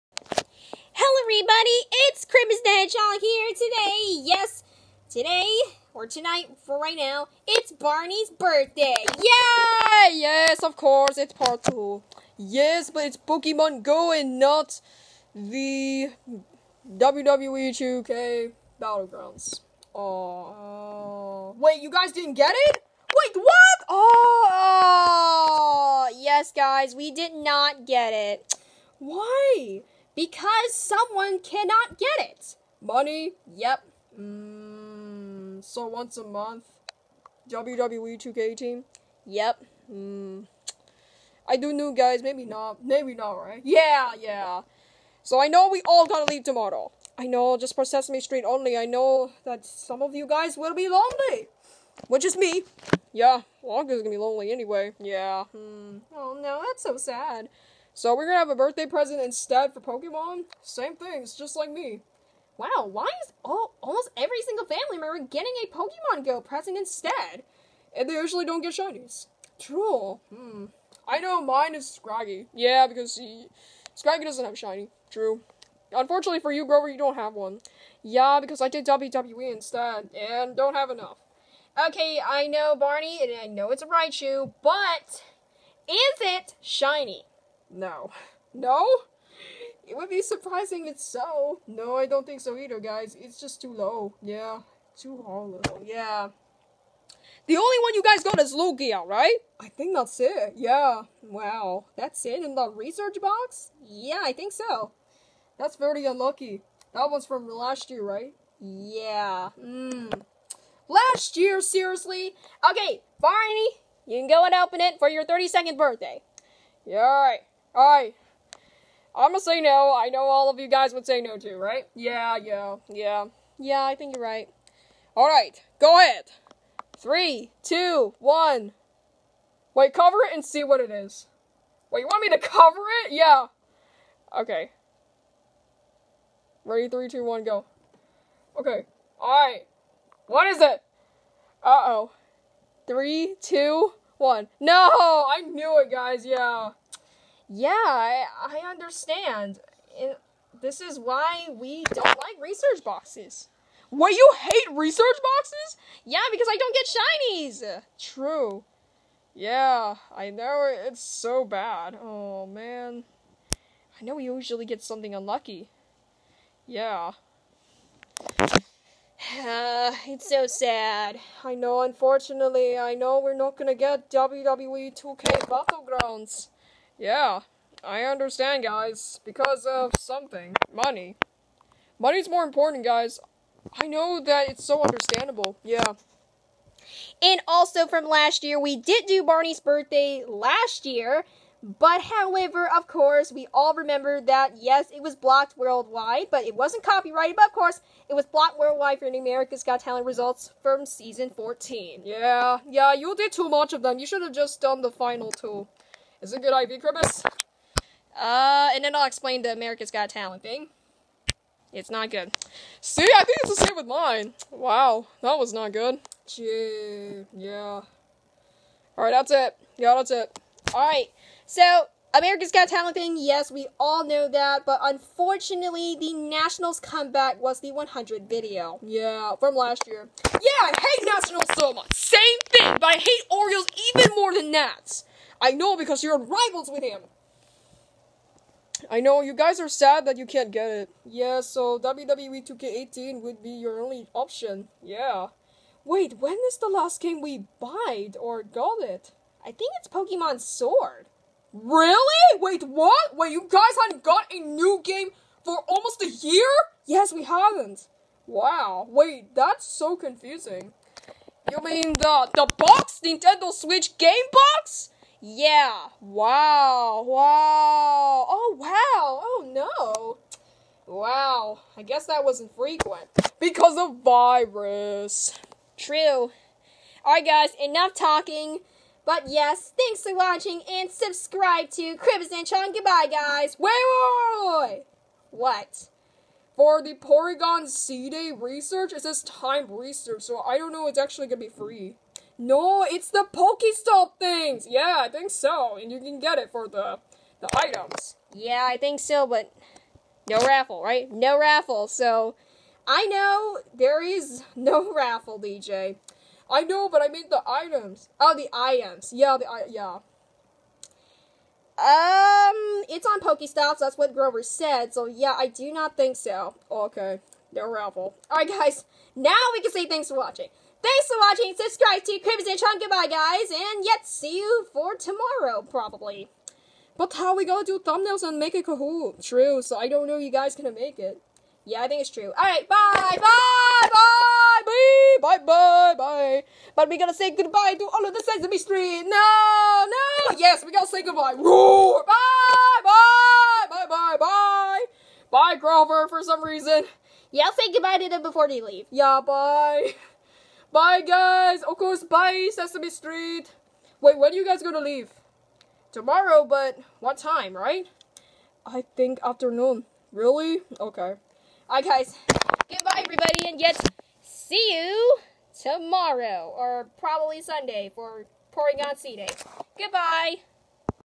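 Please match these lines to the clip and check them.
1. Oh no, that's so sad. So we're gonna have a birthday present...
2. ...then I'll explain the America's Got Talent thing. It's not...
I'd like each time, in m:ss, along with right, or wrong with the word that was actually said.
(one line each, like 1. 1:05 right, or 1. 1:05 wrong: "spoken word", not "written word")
1. 0:56 right
2. 3:28 right.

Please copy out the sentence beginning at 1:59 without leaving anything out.
I know all of you guys would say no too, right?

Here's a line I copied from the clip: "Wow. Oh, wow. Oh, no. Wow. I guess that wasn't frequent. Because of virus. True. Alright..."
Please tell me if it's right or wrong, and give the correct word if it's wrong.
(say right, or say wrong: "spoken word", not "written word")
right.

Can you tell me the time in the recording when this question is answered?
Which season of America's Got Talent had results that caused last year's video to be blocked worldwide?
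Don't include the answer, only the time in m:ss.
3:20.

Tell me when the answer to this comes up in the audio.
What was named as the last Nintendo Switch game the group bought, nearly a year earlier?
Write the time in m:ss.
4:09.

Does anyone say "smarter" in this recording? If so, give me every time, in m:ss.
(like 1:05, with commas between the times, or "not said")
not said.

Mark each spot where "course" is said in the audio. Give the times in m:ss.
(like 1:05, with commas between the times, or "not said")
0:10, 3:12, 3:17, 5:51.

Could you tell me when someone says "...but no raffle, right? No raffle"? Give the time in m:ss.
4:59.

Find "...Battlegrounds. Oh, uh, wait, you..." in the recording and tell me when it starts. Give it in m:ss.
0:18.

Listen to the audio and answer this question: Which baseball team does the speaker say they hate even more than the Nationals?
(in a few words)
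Orioles.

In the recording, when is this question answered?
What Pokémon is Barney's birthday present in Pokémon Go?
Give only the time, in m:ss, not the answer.
1:23.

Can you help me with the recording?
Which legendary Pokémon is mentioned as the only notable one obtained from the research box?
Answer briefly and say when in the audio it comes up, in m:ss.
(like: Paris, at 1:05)
Lugia, at 1:38.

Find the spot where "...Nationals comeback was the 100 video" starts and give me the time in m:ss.
3:46.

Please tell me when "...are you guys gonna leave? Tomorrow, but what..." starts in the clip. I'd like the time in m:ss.
5:54.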